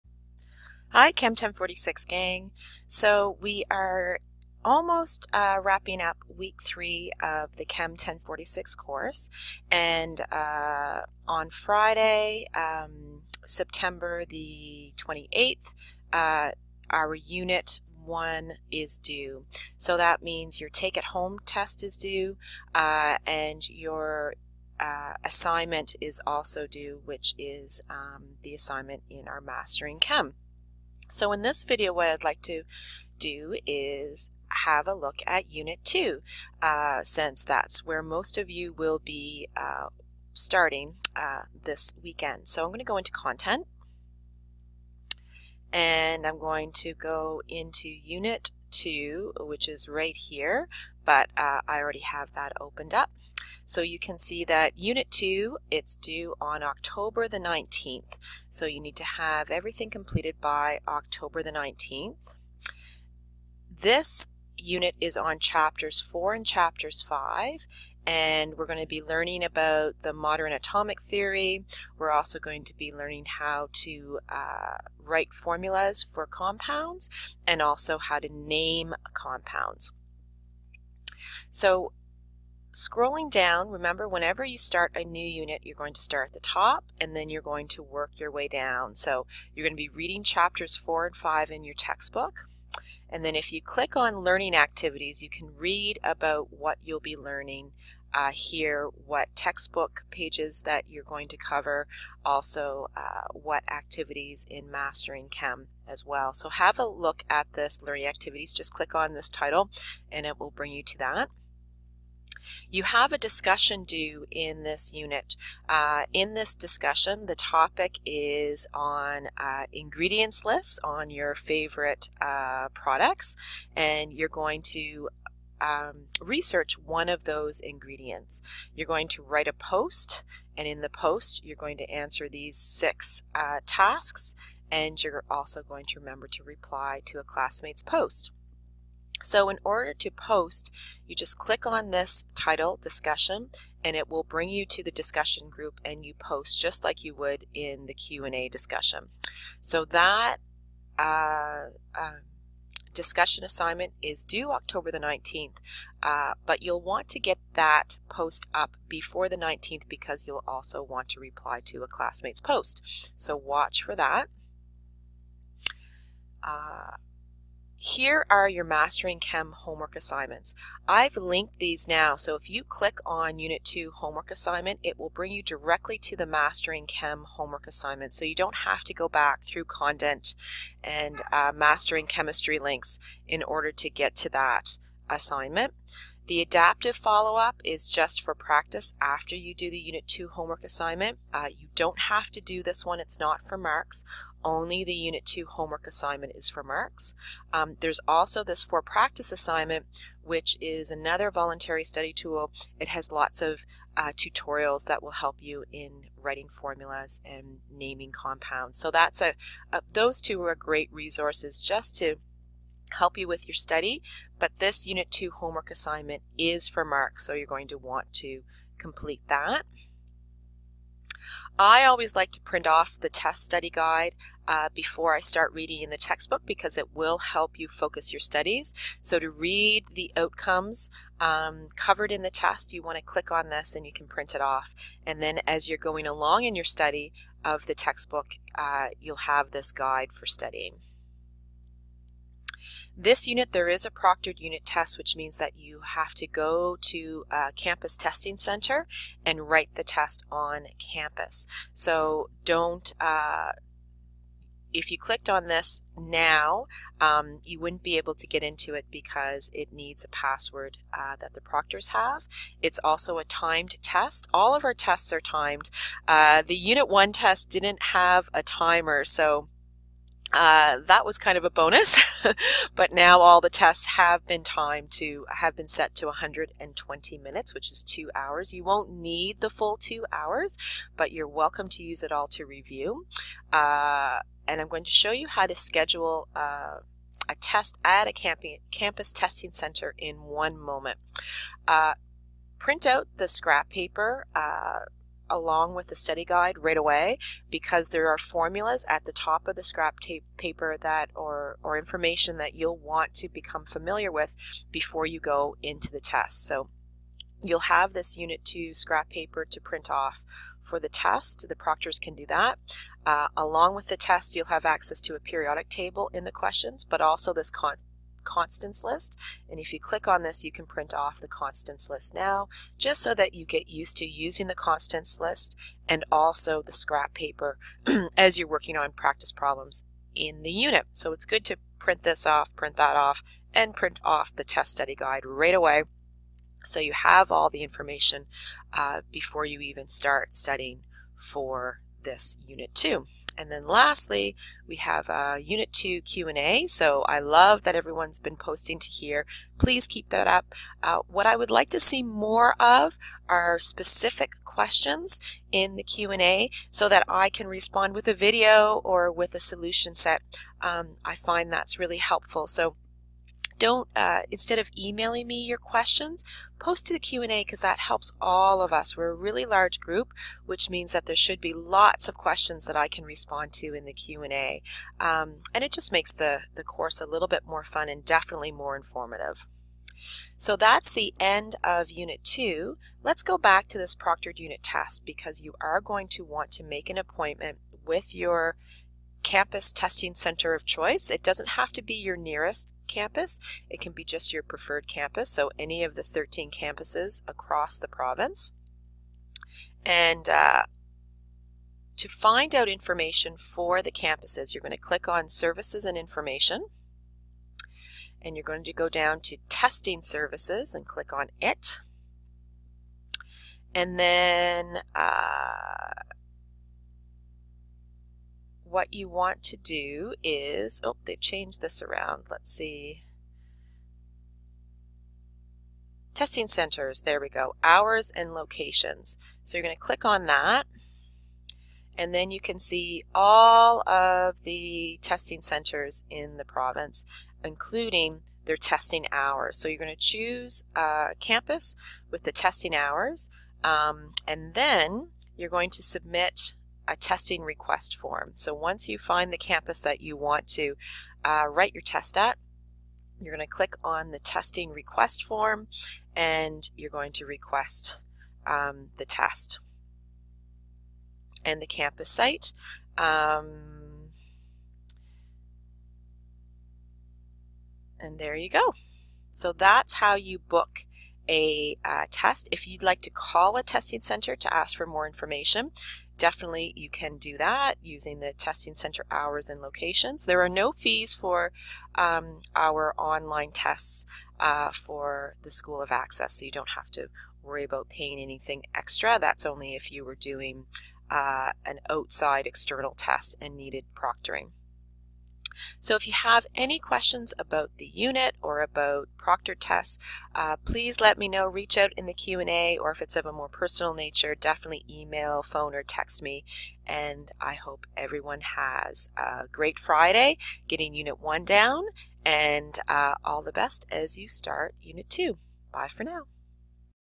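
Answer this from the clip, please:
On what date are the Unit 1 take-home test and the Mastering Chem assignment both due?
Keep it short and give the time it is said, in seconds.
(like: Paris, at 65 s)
September 28, at 13 s.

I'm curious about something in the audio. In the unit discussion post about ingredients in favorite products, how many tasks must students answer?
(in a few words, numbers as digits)
6.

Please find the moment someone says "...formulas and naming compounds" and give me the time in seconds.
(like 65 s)
206 s.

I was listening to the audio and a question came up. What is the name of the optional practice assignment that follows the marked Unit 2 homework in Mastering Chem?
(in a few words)
adaptive follow-up.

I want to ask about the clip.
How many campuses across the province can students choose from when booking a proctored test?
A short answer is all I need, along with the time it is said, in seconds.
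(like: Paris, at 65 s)
13, at 396 s.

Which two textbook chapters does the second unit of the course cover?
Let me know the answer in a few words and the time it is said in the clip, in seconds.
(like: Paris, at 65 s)
chapters 4 and 5, at 65 s.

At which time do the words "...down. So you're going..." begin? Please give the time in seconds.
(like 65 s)
88 s.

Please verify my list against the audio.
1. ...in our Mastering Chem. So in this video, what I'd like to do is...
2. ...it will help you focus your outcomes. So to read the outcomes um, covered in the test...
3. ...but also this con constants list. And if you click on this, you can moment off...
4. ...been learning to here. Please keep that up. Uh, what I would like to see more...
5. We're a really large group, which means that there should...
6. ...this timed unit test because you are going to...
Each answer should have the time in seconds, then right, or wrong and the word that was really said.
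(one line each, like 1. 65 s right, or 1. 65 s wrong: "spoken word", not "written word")
1. 29 s right
2. 226 s wrong: "studies", not "outcomes"
3. 316 s wrong: "print", not "moment"
4. 348 s wrong: "posting", not "learning"
5. 368 s right
6. 383 s wrong: "proctored", not "timed".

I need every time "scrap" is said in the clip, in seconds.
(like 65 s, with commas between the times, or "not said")
293 s, 299 s, 308 s, 326 s.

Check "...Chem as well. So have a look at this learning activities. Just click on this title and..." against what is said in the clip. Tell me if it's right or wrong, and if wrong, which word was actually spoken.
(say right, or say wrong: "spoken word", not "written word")
right.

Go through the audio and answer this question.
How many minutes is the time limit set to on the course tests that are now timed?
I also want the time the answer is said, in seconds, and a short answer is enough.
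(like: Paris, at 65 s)
120, at 276 s.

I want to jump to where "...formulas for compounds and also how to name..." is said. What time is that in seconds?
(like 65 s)
75 s.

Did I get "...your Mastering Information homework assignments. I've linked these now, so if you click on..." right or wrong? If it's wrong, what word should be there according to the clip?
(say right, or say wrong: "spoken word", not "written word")
wrong: "Chem", not "Information".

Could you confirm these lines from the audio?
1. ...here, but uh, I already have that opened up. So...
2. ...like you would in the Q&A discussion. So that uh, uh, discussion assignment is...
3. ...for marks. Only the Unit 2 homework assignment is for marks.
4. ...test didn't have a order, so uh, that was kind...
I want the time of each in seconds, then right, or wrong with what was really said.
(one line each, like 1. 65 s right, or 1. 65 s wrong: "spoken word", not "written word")
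1. 50 s right
2. 146 s right
3. 193 s right
4. 267 s wrong: "timer", not "order".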